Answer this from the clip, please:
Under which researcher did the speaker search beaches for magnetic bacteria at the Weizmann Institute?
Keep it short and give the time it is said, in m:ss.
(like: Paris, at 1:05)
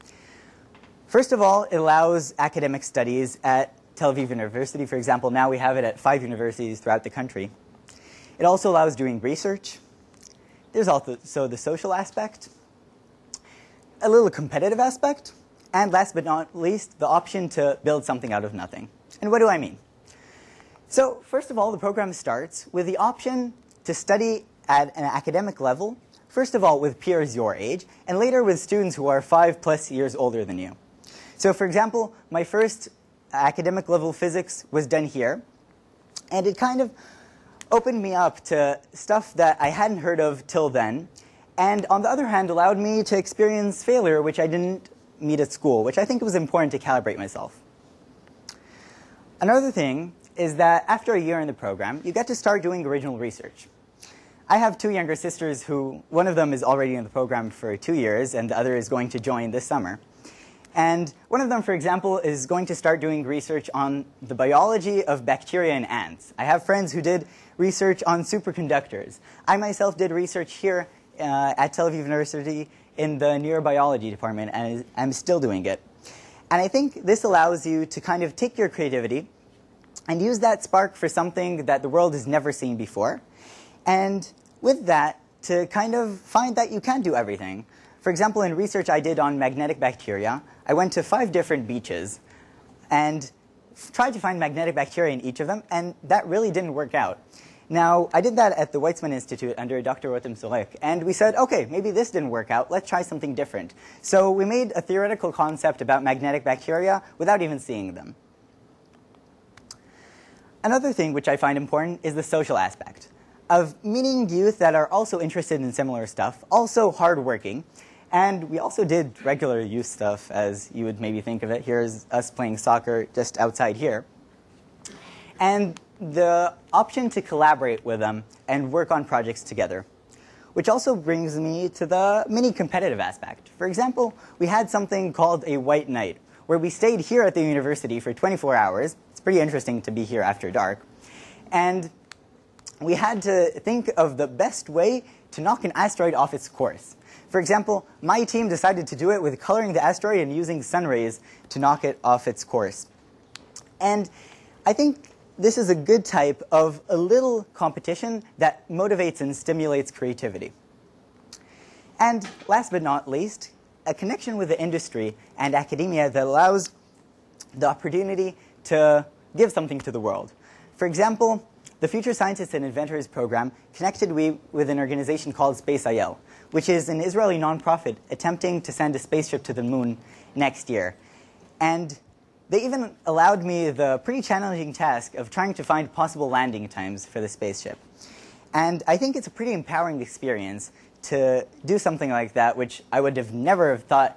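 Dr. Rotem Sorek, at 1:39.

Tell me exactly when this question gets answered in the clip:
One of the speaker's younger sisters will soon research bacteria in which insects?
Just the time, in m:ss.
1:05.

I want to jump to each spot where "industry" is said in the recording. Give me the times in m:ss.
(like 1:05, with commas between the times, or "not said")
2:44.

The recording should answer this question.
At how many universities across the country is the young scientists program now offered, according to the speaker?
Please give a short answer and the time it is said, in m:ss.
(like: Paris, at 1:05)
5, at 0:05.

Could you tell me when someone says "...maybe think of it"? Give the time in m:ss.
2:00.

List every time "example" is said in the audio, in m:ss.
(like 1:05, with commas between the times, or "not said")
0:04, 0:31, 1:01, 1:28, 2:13, 2:27, 2:50.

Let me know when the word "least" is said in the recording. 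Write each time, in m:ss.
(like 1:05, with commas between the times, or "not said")
0:16, 2:43.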